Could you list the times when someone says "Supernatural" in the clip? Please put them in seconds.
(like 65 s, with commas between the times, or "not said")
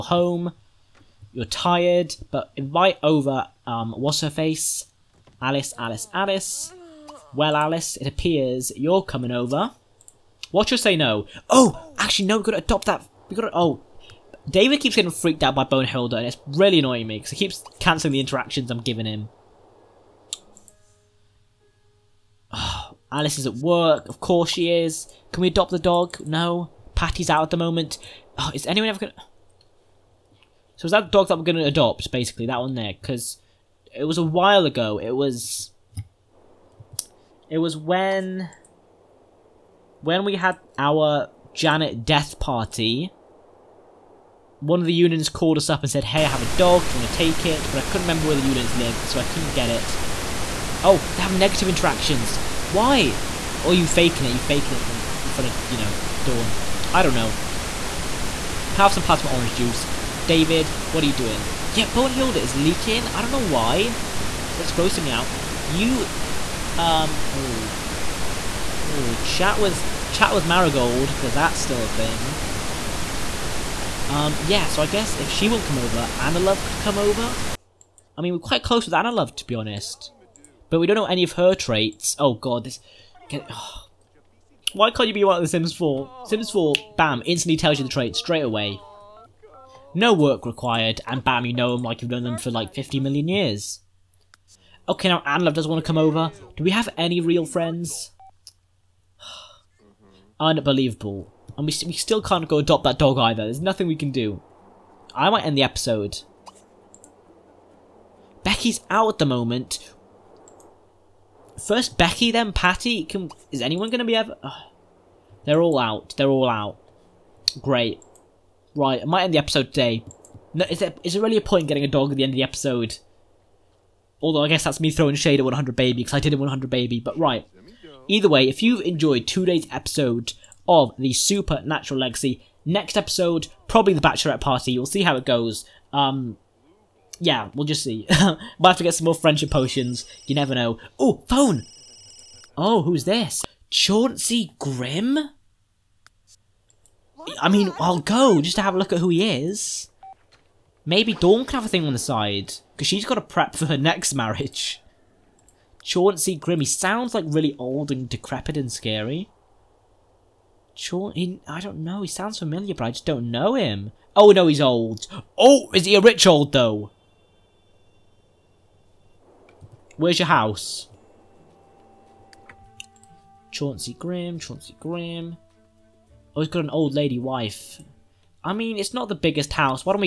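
131 s.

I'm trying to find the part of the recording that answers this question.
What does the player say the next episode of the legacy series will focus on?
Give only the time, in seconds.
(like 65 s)
133 s.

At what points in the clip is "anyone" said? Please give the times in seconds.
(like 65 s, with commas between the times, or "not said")
28 s, 113 s.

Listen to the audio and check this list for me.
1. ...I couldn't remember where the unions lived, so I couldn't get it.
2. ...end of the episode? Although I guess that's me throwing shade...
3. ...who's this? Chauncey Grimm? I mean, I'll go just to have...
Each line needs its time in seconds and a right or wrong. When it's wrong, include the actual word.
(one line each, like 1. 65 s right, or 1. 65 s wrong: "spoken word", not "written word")
1. 47 s right
2. 122 s right
3. 142 s right.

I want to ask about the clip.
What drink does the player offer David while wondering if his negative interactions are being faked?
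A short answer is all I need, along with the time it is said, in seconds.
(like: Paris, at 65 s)
Plasma orange juice, at 59 s.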